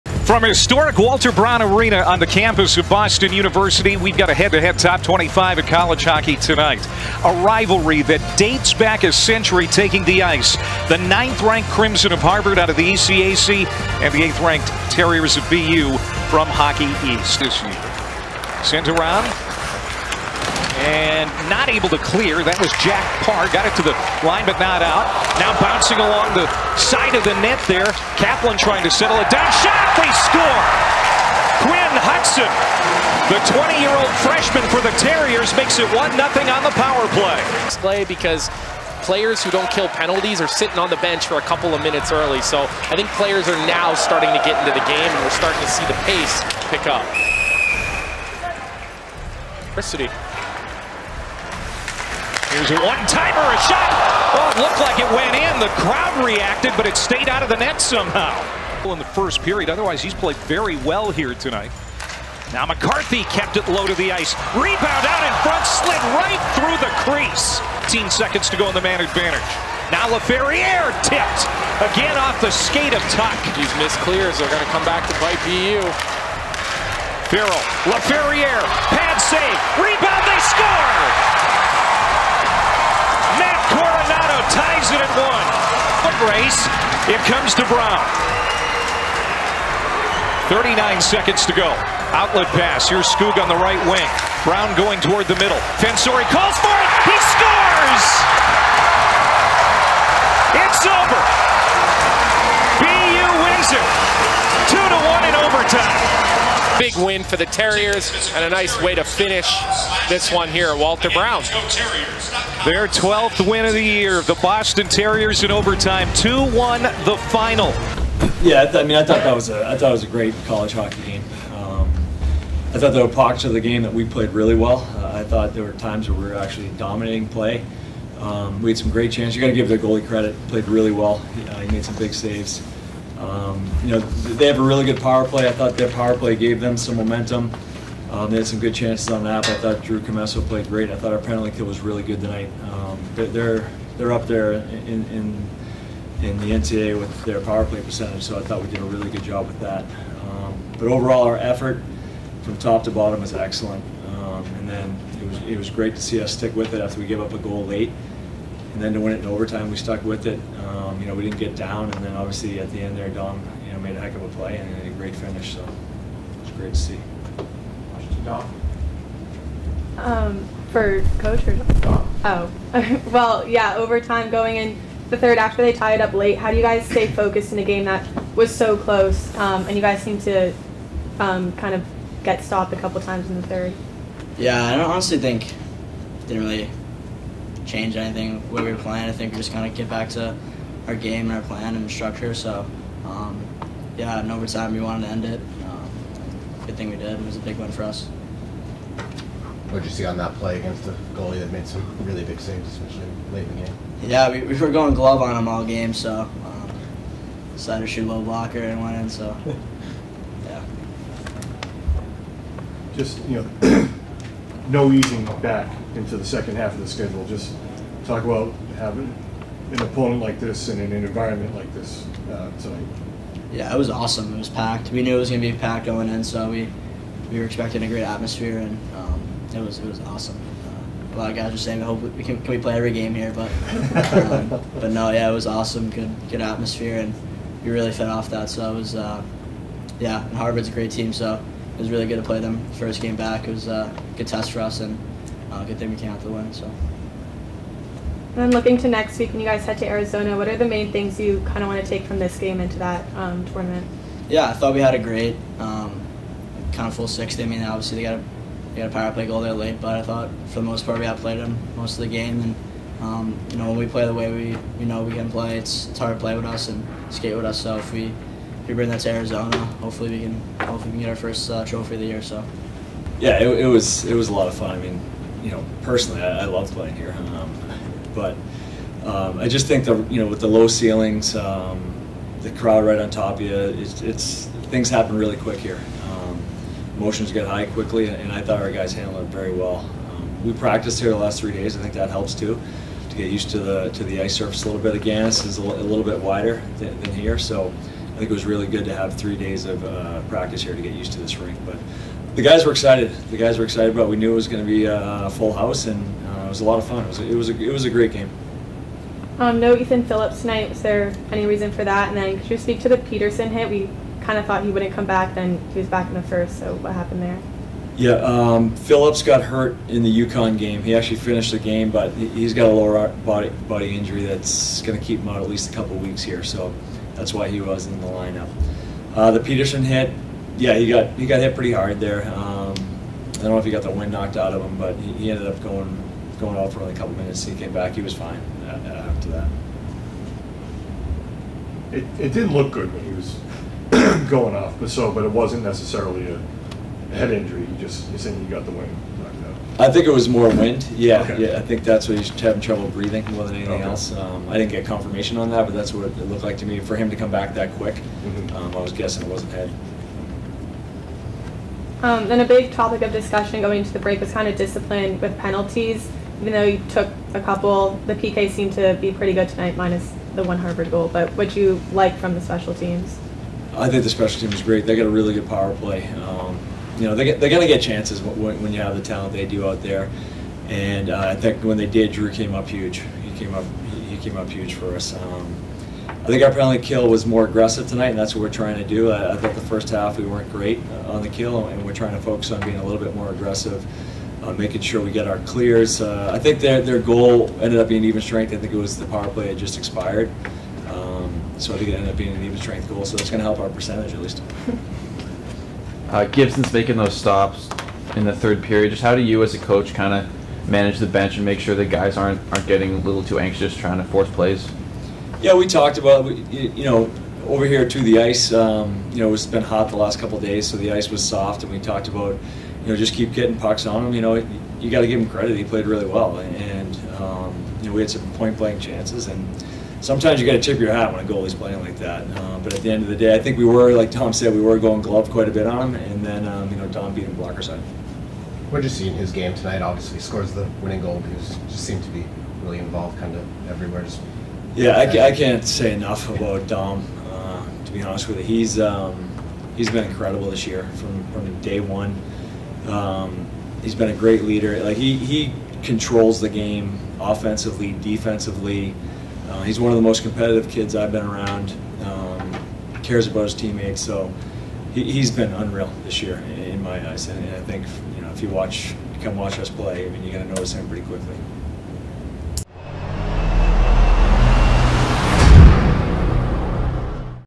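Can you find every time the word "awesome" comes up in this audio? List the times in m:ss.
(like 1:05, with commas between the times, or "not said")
3:43, 3:50, 3:55.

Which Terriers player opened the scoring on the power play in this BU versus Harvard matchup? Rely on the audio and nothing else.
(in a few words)
Quinn Hutson.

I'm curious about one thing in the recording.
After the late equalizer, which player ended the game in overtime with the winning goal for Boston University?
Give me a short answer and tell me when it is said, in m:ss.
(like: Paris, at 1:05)
Fensore, at 1:35.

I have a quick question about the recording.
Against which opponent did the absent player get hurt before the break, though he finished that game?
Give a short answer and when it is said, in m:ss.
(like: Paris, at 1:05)
UConn, at 5:20.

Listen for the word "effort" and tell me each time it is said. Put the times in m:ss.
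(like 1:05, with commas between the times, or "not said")
2:31.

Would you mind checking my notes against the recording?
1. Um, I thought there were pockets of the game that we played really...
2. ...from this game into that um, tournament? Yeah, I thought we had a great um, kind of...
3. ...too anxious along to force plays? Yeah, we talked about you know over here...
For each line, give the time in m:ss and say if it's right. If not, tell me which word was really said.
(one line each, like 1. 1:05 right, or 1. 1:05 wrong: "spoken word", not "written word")
1. 2:01 right
2. 4:12 right
3. 6:53 wrong: "trying", not "along".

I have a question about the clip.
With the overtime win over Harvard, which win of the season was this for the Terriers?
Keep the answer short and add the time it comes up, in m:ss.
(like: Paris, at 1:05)
12th, at 1:52.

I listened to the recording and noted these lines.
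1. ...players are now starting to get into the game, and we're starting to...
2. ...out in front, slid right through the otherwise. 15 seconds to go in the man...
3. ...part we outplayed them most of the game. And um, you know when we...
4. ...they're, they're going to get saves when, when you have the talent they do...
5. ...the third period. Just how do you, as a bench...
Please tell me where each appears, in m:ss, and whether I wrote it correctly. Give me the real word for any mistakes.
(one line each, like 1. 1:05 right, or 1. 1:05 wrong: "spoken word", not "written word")
1. 0:43 right
2. 1:05 wrong: "crease", not "otherwise"
3. 4:20 right
4. 6:17 wrong: "chances", not "saves"
5. 6:48 wrong: "coach", not "bench".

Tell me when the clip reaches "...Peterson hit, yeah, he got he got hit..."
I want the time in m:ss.
5:29.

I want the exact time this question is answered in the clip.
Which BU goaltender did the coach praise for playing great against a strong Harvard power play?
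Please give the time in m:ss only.
2:19.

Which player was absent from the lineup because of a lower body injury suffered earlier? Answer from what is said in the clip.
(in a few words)
Ethan Phillips.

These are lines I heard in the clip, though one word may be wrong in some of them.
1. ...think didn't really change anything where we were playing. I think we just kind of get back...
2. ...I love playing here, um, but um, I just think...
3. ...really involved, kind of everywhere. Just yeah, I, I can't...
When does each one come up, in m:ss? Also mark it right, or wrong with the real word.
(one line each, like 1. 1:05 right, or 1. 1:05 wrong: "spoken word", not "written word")
1. 3:05 right
2. 4:36 right
3. 7:22 right.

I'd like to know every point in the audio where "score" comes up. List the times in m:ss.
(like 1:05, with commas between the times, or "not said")
0:30, 1:20, 1:37, 7:20.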